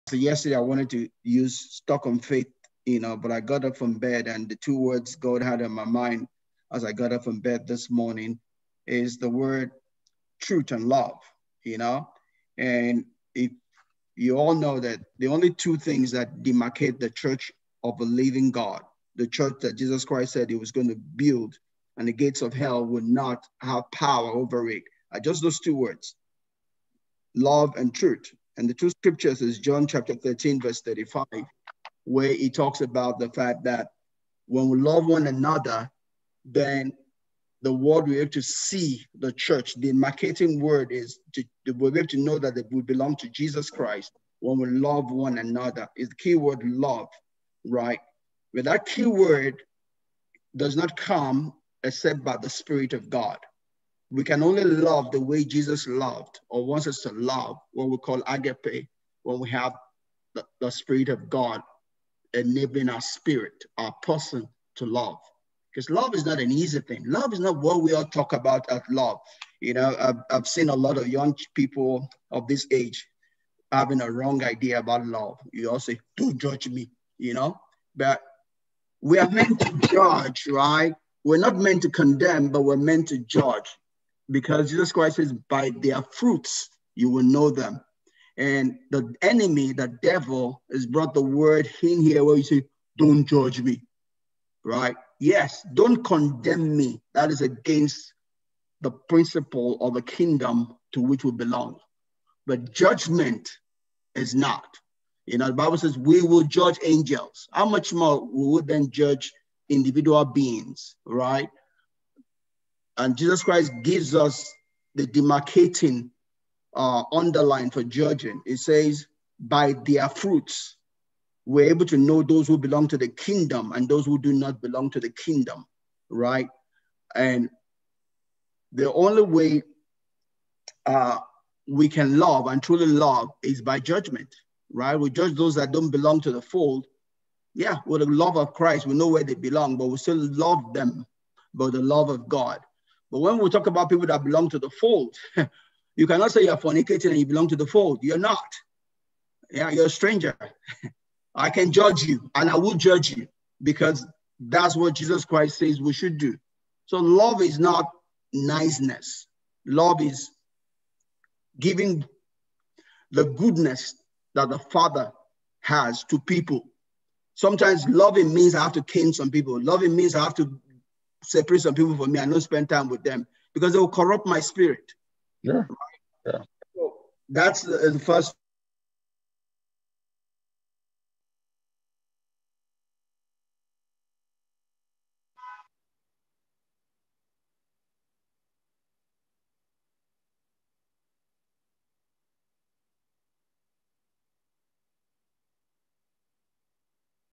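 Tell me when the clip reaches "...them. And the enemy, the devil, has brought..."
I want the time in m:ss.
1:27.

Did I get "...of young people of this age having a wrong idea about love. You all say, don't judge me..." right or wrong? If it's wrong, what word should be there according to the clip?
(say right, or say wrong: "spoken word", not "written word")
right.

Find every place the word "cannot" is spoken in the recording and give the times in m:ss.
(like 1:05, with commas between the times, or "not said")
2:26.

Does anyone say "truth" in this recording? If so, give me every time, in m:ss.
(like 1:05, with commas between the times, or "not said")
0:10, 0:27.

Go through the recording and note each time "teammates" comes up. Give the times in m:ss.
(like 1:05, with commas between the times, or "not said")
not said.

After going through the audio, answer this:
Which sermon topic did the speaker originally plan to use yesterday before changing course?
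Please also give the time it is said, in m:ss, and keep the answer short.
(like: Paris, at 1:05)
Stuck on faith, at 0:01.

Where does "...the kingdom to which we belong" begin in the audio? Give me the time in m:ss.
1:39.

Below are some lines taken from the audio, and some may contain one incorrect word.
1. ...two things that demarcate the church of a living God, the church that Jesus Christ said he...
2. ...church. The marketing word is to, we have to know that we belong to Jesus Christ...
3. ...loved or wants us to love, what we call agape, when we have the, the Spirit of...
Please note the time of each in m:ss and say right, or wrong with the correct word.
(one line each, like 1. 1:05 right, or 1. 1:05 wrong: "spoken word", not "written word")
1. 0:15 right
2. 0:39 right
3. 0:55 right.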